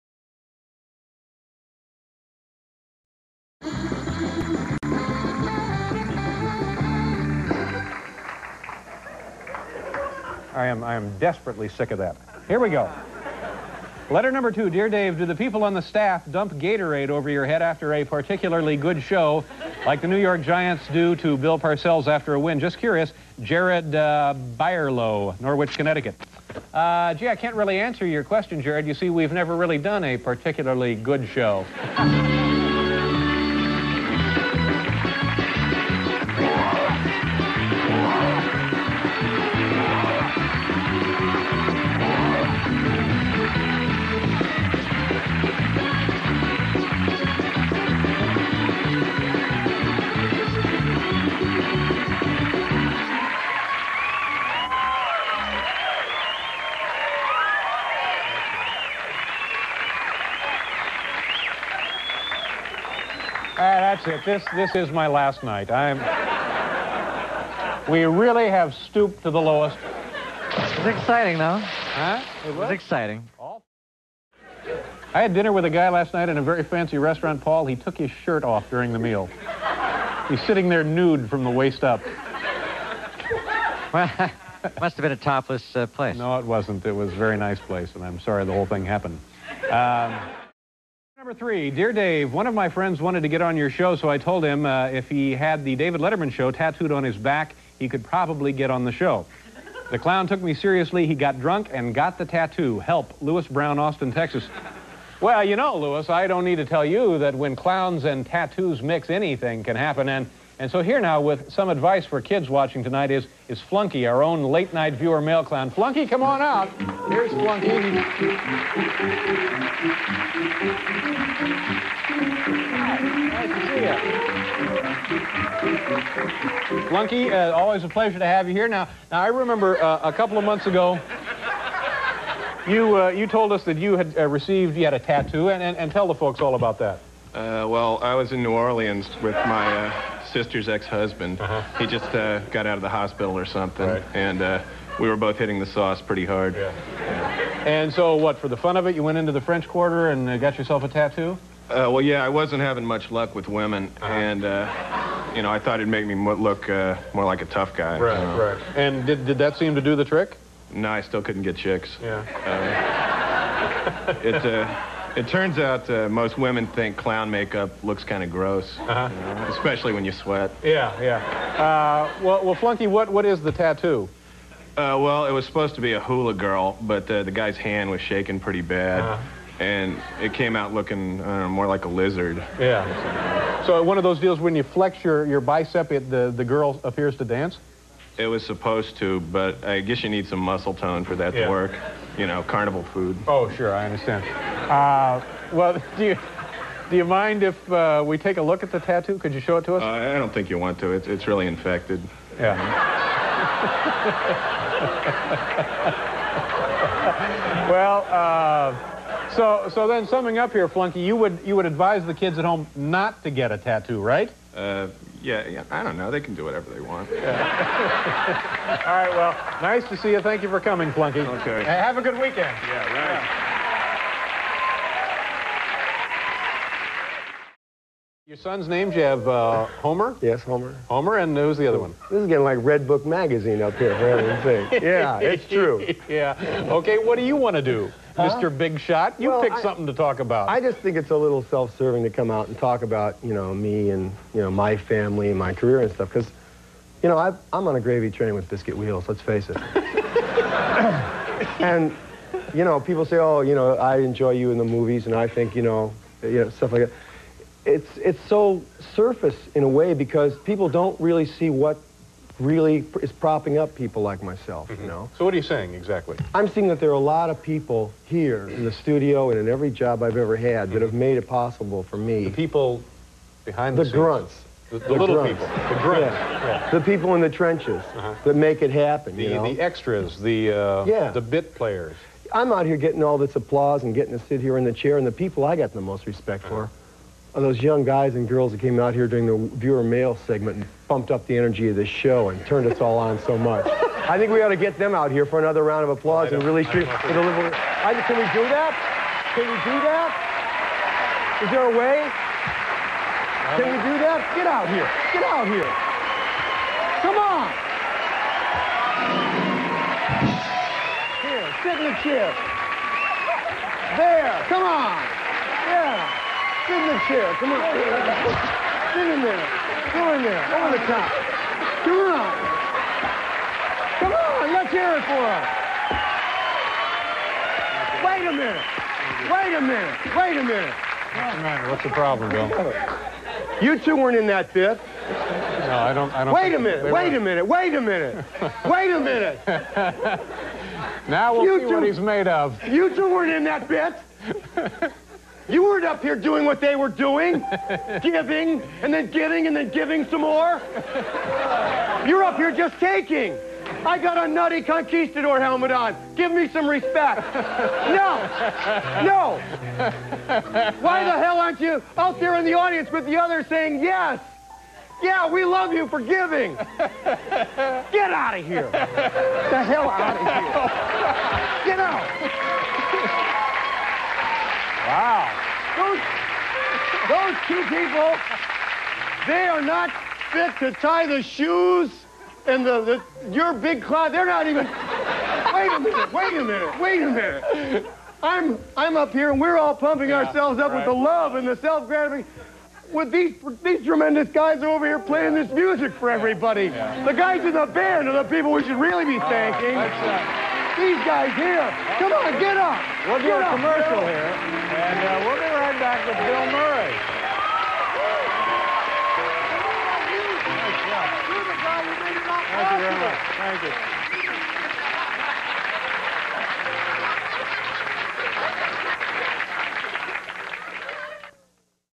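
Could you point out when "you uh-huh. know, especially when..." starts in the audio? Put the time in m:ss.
2:48.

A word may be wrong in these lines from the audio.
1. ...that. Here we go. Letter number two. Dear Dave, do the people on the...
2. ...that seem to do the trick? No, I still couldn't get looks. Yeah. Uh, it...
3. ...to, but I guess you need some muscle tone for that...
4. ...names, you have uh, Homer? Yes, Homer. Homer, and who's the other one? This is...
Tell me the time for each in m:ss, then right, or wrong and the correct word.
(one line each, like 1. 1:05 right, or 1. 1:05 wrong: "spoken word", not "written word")
1. 0:11 right
2. 2:39 wrong: "chicks", not "looks"
3. 3:08 right
4. 3:48 right.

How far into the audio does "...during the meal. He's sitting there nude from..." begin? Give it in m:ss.
1:18.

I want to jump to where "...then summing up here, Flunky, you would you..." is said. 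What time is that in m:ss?
3:29.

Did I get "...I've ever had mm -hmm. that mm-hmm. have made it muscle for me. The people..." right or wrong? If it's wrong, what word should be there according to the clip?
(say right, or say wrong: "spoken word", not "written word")
wrong: "possible", not "muscle".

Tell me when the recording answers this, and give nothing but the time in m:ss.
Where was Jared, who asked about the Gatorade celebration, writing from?
0:24.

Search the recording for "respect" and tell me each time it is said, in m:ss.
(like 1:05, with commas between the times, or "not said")
4:46, 5:56.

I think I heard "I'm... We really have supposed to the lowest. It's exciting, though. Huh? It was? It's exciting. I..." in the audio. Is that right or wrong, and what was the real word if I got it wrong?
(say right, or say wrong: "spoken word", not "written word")
wrong: "stooped", not "supposed".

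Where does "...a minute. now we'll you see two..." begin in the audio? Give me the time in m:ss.
5:38.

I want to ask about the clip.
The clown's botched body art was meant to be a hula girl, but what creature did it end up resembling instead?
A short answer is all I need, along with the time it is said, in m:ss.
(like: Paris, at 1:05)
A lizard, at 3:01.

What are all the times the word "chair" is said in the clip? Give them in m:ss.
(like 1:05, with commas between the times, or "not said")
4:44, 5:12, 5:17.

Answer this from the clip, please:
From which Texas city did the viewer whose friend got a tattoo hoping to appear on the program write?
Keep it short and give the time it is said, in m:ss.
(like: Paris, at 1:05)
Austin, at 1:43.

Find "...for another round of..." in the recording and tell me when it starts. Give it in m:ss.
4:55.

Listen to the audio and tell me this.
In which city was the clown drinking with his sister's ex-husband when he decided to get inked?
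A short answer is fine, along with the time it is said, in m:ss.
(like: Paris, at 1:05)
New Orleans, at 2:18.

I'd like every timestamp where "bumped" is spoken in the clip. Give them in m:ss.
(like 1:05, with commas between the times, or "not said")
4:50.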